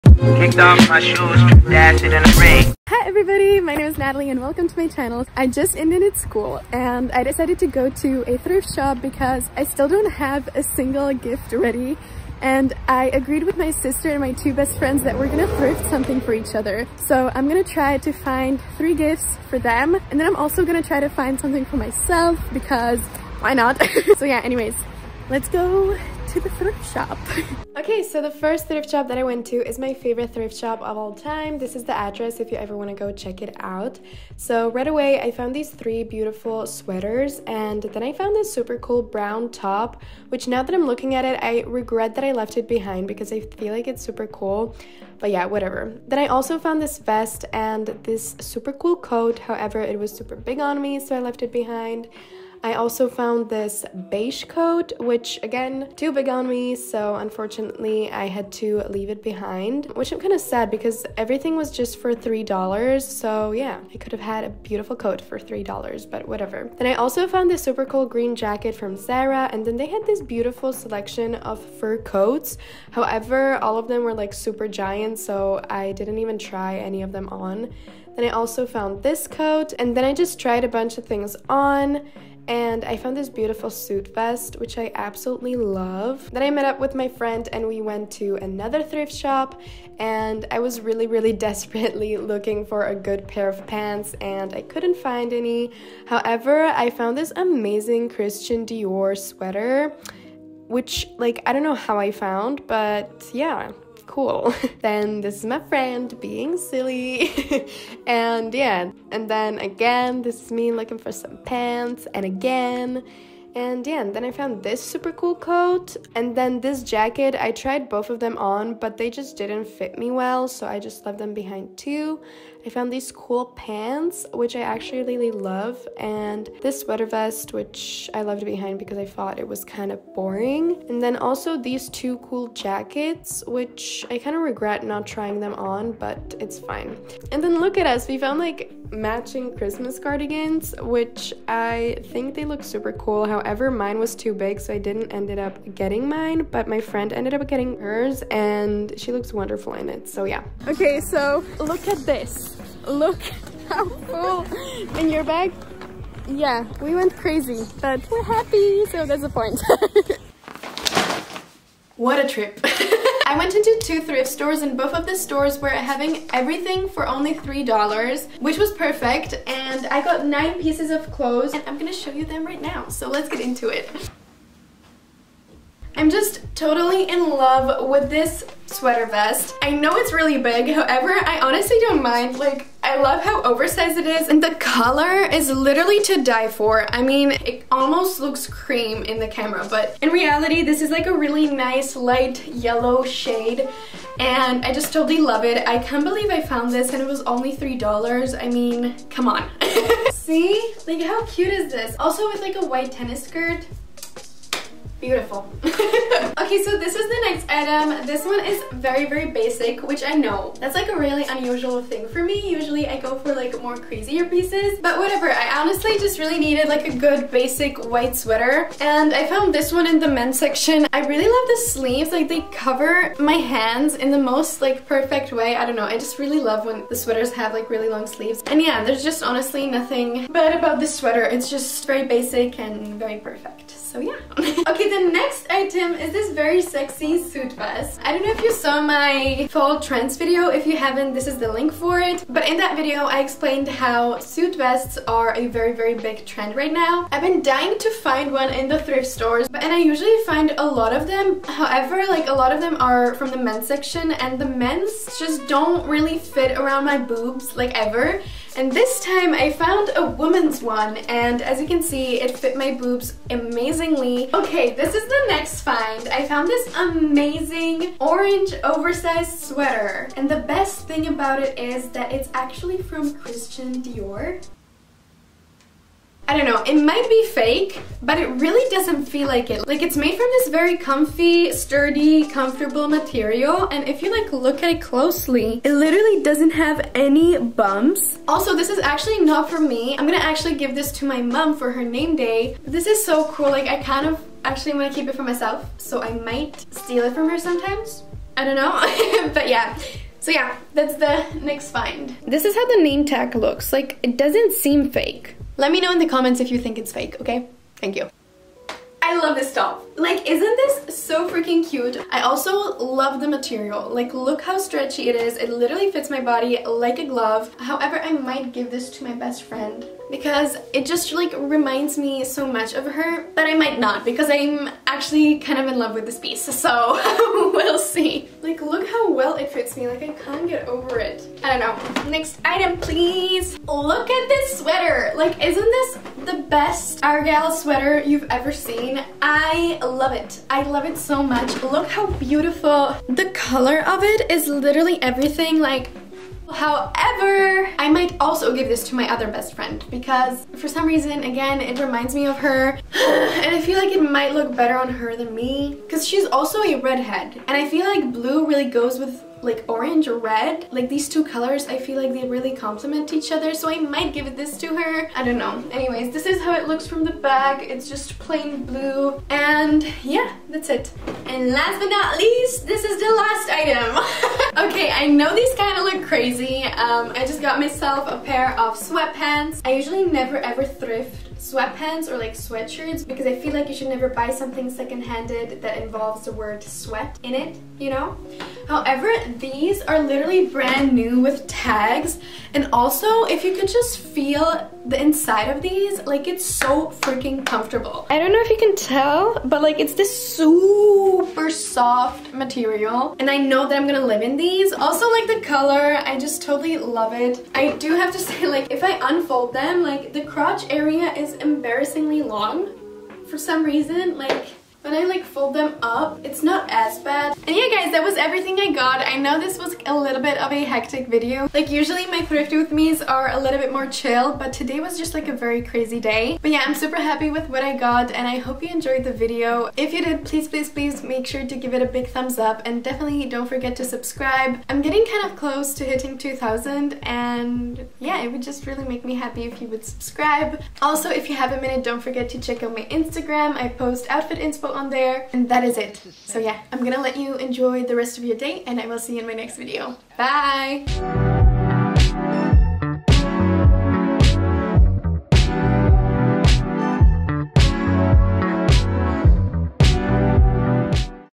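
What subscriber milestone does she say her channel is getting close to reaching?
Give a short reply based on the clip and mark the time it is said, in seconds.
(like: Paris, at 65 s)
2000, at 436 s.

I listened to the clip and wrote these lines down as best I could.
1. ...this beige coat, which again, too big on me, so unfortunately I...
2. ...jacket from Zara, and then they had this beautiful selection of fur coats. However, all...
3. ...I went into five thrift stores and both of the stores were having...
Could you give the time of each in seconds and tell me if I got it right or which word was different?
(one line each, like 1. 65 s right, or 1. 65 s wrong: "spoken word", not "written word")
1. 53 s right
2. 68 s right
3. 163 s wrong: "two", not "five".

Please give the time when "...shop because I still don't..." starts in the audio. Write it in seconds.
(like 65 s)
8 s.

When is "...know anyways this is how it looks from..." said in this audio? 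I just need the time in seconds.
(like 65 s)
365 s.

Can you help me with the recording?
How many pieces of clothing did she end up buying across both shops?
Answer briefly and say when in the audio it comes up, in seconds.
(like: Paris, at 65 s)
9, at 170 s.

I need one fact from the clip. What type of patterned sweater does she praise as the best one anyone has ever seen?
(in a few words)
Argyle sweater.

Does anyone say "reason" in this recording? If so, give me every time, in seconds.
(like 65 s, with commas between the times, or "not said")
350 s, 413 s.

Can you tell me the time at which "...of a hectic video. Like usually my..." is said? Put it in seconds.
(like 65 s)
420 s.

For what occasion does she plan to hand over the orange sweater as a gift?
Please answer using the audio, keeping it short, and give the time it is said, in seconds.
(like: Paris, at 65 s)
Her name day, at 291 s.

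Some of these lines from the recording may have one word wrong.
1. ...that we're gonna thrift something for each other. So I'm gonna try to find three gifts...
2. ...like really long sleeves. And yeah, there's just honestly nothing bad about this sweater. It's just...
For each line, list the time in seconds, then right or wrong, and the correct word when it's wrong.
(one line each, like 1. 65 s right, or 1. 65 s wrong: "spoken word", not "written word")
1. 15 s right
2. 227 s right.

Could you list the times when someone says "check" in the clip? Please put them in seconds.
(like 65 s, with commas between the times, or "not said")
33 s, 442 s.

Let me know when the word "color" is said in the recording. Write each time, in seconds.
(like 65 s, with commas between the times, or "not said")
184 s, 343 s, 361 s, 405 s.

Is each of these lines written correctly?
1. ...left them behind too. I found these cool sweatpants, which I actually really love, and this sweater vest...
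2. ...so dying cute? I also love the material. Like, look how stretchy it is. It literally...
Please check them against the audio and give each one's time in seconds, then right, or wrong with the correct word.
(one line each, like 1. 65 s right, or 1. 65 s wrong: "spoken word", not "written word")
1. 121 s wrong: "pants", not "sweatpants"
2. 311 s wrong: "freaking", not "dying".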